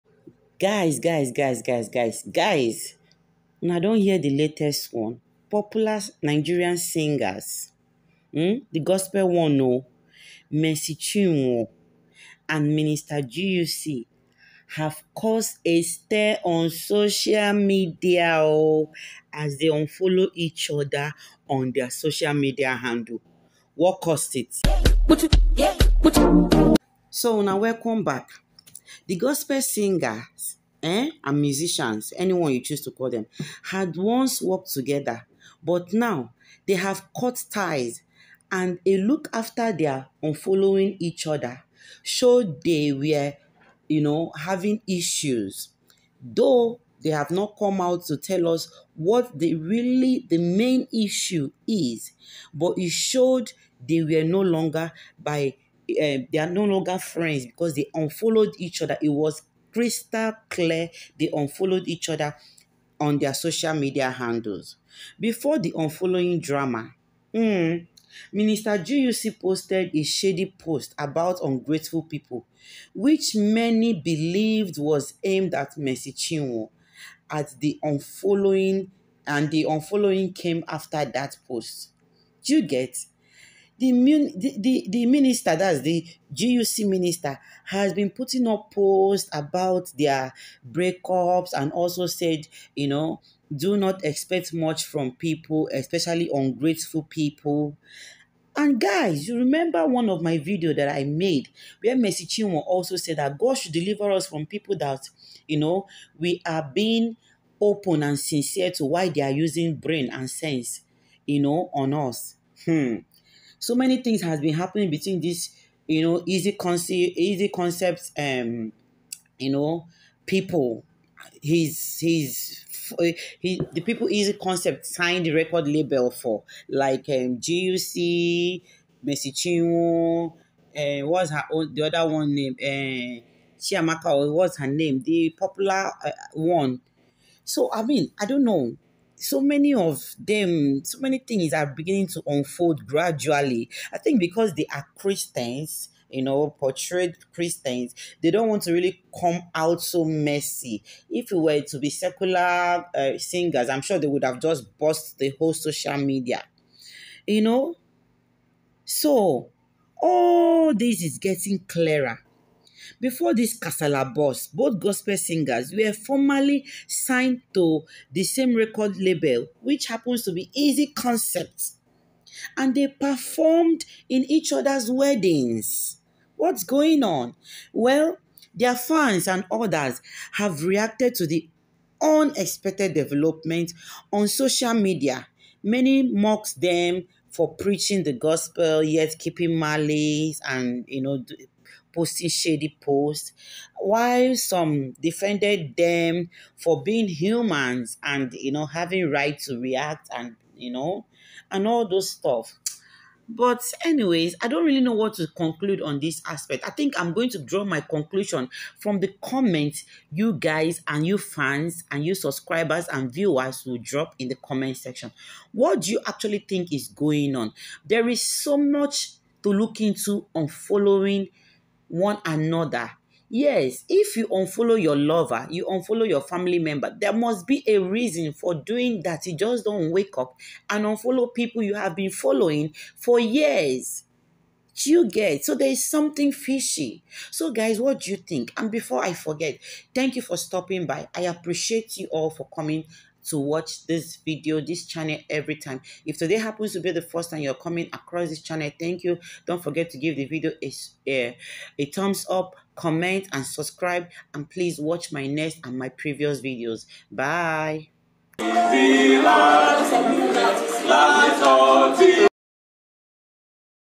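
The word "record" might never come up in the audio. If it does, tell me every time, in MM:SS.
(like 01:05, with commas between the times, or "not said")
02:05, 02:48.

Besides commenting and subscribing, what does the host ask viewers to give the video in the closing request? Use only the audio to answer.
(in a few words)
thumbs up.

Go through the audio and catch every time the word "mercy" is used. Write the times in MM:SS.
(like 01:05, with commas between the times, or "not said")
00:10, 01:15, 01:41, 02:09.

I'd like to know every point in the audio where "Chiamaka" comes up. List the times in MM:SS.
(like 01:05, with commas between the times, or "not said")
02:13.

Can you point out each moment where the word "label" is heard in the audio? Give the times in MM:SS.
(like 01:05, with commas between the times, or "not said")
02:05, 02:48.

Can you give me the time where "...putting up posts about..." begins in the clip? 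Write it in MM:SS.
01:28.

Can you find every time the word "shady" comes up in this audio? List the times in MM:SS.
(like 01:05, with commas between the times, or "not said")
01:10, 03:12.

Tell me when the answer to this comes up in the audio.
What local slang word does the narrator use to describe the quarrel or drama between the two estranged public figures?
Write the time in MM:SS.
02:43.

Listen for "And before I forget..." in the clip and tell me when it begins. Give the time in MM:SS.
03:58.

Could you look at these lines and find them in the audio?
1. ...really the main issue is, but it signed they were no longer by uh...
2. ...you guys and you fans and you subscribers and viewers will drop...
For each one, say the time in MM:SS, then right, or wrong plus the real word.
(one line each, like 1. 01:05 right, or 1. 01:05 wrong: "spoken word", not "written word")
1. 00:49 wrong: "showed", not "signed"
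2. 03:30 right.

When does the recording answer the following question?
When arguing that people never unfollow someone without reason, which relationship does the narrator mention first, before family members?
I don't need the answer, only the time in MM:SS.
03:44.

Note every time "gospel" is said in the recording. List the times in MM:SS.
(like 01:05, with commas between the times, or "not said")
00:08, 00:29, 02:44, 03:08.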